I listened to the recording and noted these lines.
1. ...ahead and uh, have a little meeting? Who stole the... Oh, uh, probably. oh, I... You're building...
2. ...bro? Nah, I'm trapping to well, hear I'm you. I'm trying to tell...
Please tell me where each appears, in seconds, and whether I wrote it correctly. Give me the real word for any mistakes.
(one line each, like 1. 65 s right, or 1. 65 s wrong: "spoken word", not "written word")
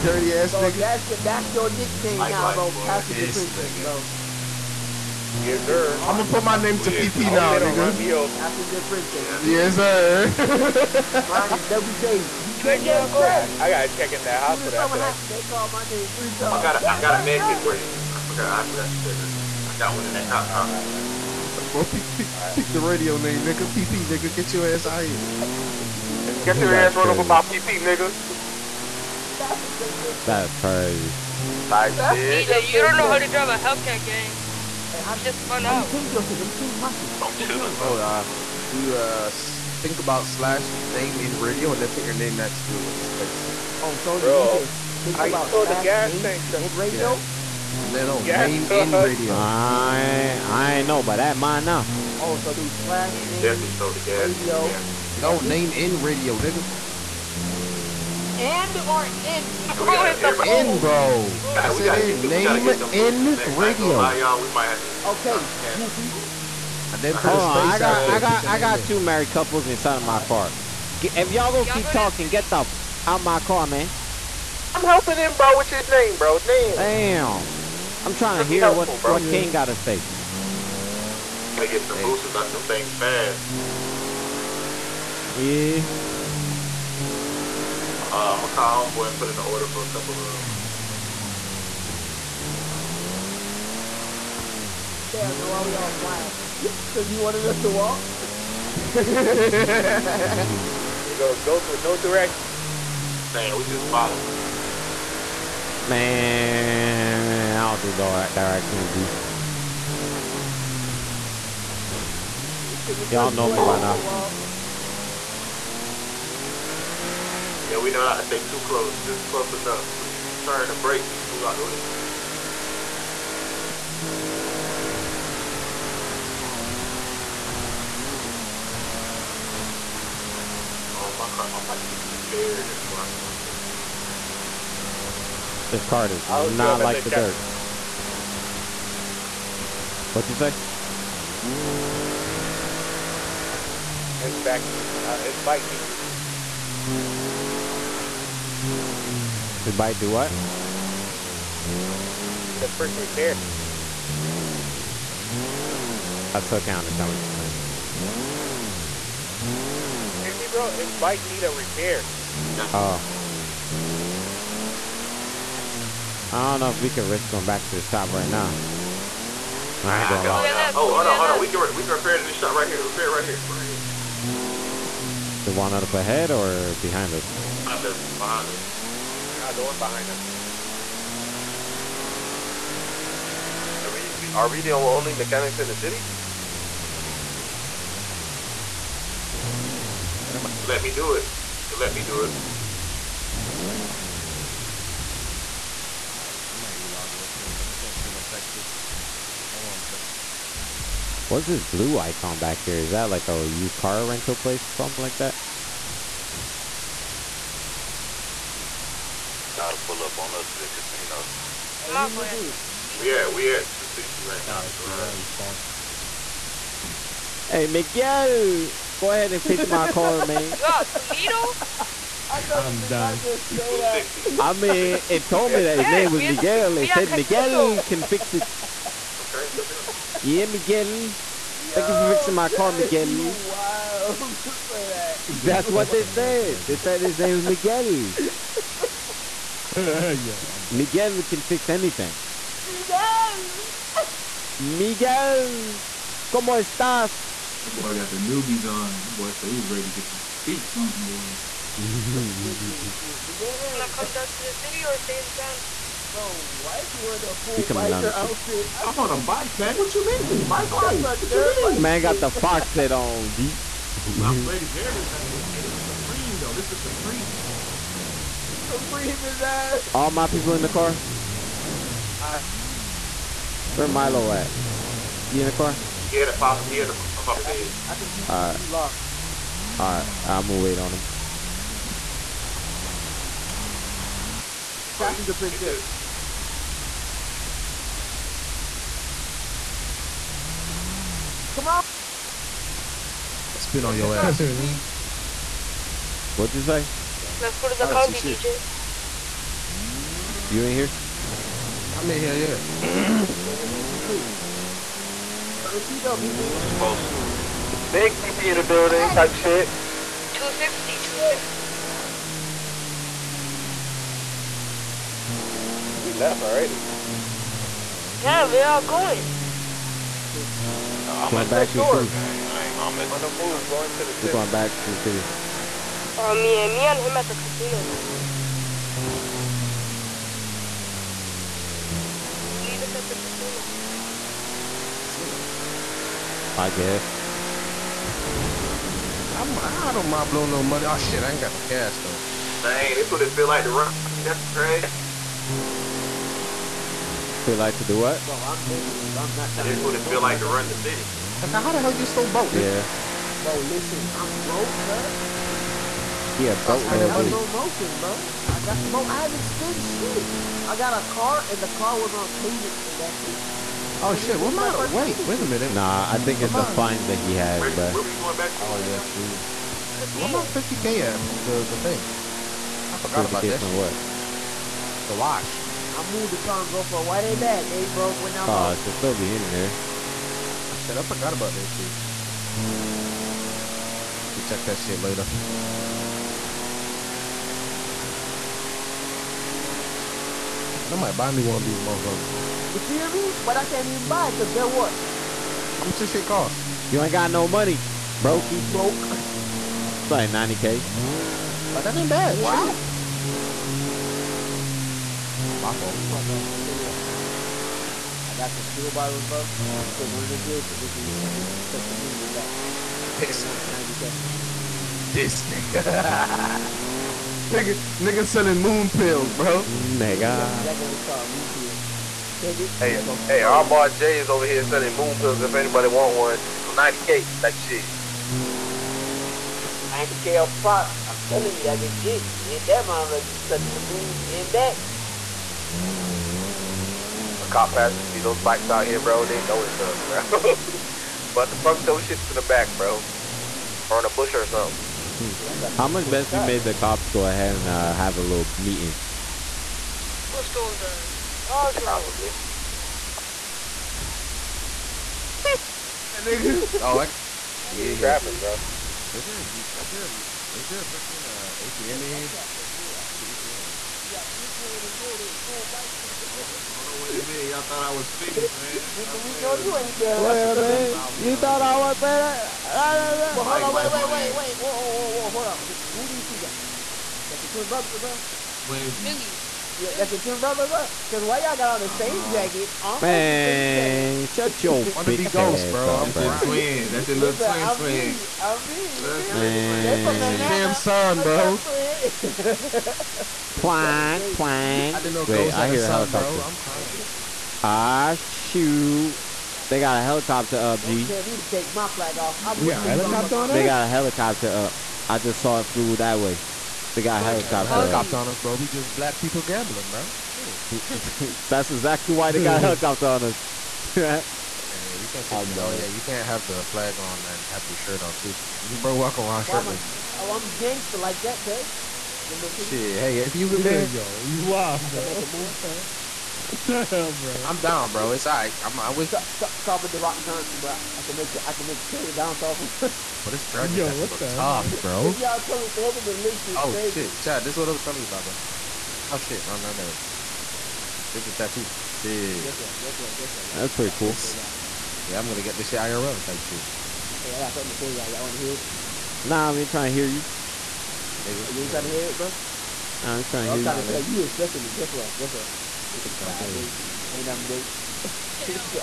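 1. 447 s wrong: "trapping", not "building"
2. 552 s wrong: "trying", not "trapping".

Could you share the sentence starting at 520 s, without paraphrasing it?
Oh, I'm gangster like that, cuz.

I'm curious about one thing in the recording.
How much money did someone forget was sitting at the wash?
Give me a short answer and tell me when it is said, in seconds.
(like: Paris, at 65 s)
50k, at 370 s.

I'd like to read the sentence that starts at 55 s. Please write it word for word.
No name in radio, nigga and or in?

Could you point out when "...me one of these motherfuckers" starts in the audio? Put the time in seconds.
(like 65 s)
391 s.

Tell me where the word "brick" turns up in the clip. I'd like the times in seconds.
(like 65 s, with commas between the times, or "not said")
152 s.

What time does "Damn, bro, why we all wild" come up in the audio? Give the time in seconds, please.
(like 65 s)
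95 s.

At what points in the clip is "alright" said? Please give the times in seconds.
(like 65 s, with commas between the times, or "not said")
196 s, 279 s, 528 s.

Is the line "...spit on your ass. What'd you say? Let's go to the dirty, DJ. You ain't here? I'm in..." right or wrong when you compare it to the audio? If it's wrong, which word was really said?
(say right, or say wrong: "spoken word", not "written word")
wrong: "county", not "dirty".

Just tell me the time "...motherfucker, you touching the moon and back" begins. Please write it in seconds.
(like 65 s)
432 s.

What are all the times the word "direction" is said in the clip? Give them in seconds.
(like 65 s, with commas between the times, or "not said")
101 s, 108 s.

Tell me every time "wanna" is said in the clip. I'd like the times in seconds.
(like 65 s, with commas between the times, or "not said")
253 s, 548 s.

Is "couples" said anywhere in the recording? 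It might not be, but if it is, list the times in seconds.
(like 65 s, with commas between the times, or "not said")
69 s, 89 s.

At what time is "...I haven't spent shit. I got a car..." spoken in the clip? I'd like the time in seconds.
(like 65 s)
359 s.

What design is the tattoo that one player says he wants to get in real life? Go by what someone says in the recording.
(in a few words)
Dragon.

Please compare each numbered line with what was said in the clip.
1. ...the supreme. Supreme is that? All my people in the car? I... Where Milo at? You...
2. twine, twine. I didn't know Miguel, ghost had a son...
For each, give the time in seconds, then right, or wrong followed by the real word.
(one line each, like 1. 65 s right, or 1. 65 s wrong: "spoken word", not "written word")
1. 266 s right
2. 493 s wrong: "Wait", not "Miguel".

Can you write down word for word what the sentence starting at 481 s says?
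Cause why y'all got on the same uh, jacket?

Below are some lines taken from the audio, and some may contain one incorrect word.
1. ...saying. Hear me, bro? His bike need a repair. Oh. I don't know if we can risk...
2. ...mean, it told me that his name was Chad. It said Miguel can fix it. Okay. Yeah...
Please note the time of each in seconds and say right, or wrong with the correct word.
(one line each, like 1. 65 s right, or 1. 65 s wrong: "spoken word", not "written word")
1. 160 s right
2. 224 s wrong: "Miguel", not "Chad".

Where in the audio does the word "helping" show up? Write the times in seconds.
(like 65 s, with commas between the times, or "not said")
74 s.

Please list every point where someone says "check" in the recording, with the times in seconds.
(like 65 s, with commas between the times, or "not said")
13 s, 384 s.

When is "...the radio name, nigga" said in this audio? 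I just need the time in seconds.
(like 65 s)
22 s.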